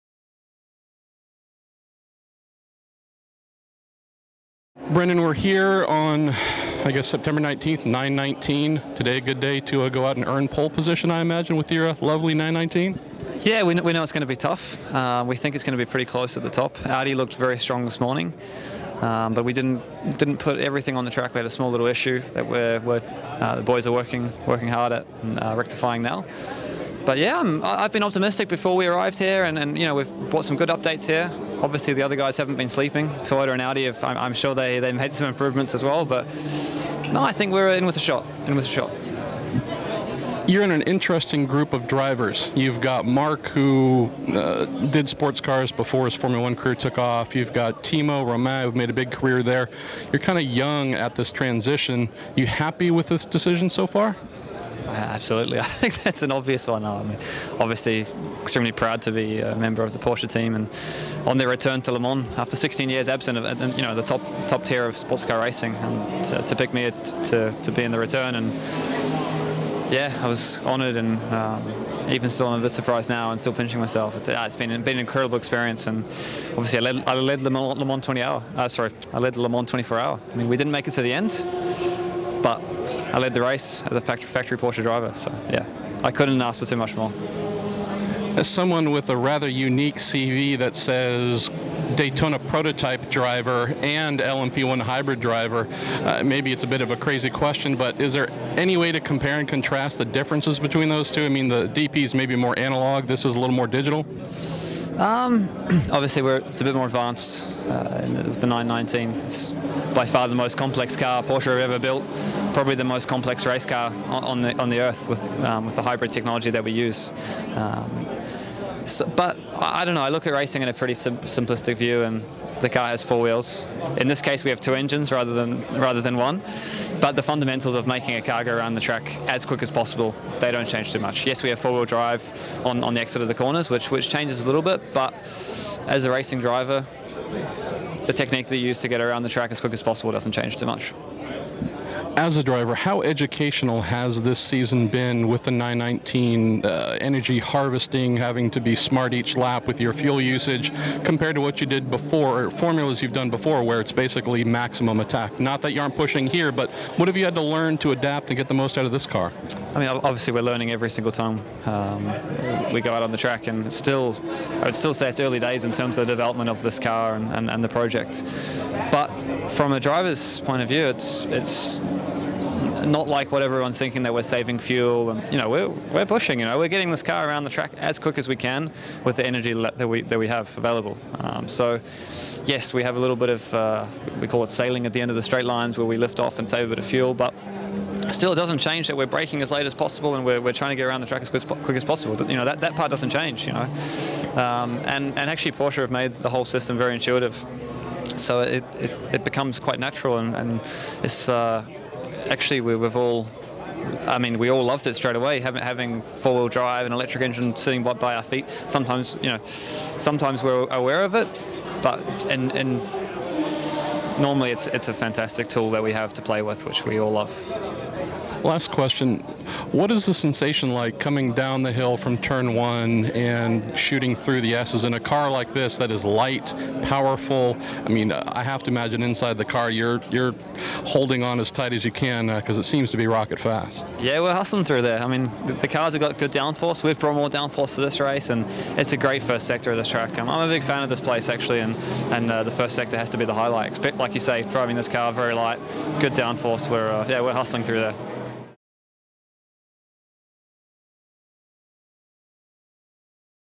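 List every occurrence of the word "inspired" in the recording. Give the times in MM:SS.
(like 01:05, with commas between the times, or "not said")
not said.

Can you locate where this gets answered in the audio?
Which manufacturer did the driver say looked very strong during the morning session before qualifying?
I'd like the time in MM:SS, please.
00:16.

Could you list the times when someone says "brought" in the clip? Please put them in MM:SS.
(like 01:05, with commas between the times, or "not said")
00:30, 03:56.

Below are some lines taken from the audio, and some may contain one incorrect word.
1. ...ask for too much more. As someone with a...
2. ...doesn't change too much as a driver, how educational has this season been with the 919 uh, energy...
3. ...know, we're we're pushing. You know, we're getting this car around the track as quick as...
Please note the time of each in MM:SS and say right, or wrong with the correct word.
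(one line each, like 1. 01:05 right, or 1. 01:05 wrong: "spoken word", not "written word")
1. 01:26 right
2. 02:20 right
3. 02:55 right.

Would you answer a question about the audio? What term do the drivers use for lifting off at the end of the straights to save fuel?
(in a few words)
Sailing.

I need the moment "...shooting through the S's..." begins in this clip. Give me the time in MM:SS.
03:43.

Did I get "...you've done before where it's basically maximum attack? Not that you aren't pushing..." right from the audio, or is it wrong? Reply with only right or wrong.
right.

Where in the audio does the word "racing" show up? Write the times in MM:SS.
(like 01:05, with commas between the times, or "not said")
01:05, 02:00, 02:16.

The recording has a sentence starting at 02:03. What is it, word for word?
In this case, we have two engines rather than rather than one.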